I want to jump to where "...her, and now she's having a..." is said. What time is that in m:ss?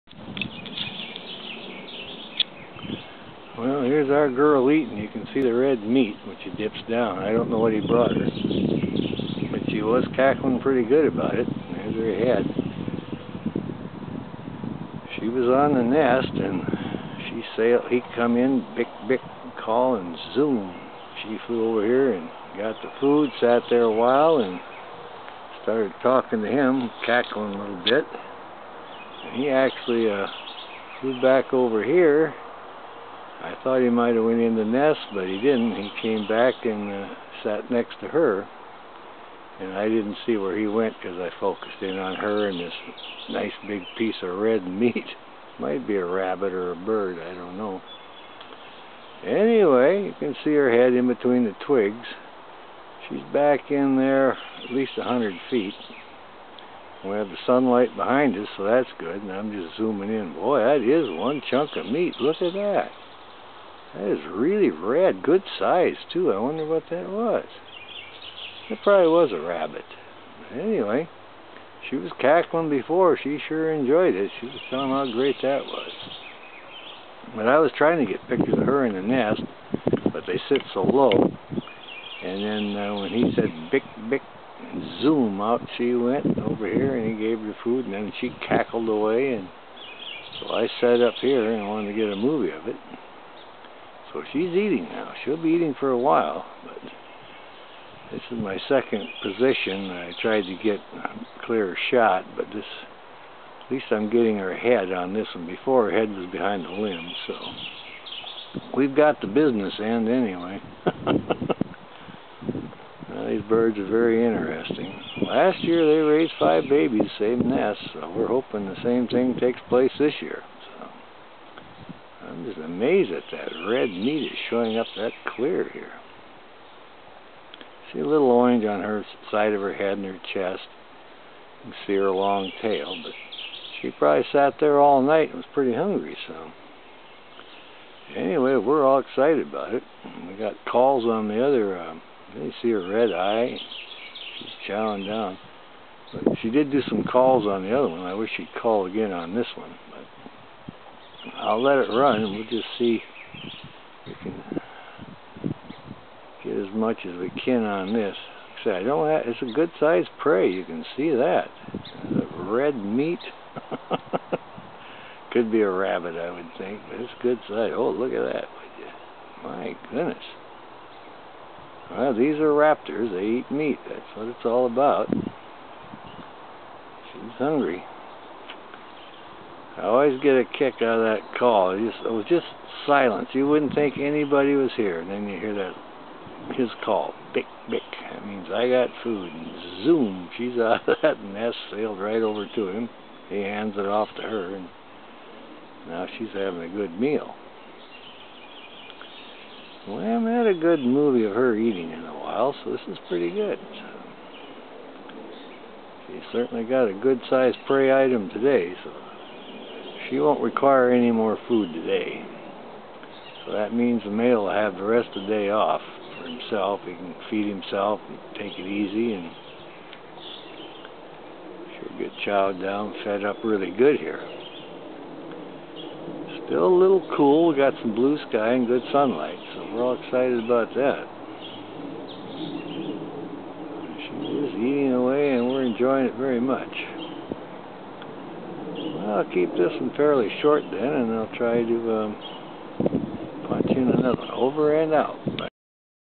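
3:14.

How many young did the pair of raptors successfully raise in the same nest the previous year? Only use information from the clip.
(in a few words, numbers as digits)
5.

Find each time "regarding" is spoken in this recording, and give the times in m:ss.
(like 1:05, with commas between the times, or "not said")
not said.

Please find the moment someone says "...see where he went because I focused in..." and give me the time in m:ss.
0:40.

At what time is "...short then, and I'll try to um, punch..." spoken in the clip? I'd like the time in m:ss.
4:00.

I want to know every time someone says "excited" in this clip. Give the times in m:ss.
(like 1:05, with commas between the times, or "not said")
2:18, 3:49.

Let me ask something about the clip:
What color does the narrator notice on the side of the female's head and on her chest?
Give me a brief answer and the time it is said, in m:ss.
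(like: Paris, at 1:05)
orange, at 2:08.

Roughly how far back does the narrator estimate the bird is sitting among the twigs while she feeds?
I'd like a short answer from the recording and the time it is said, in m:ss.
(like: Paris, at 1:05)
100 feet, at 0:54.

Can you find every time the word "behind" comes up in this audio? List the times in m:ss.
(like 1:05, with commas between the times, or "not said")
0:57, 1:46.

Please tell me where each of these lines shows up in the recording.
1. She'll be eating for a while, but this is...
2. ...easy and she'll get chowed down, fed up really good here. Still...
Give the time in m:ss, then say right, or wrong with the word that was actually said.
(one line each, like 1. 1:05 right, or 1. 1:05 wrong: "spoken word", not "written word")
1. 1:35 right
2. 3:38 right.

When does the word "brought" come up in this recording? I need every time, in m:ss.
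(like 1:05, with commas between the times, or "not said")
0:07.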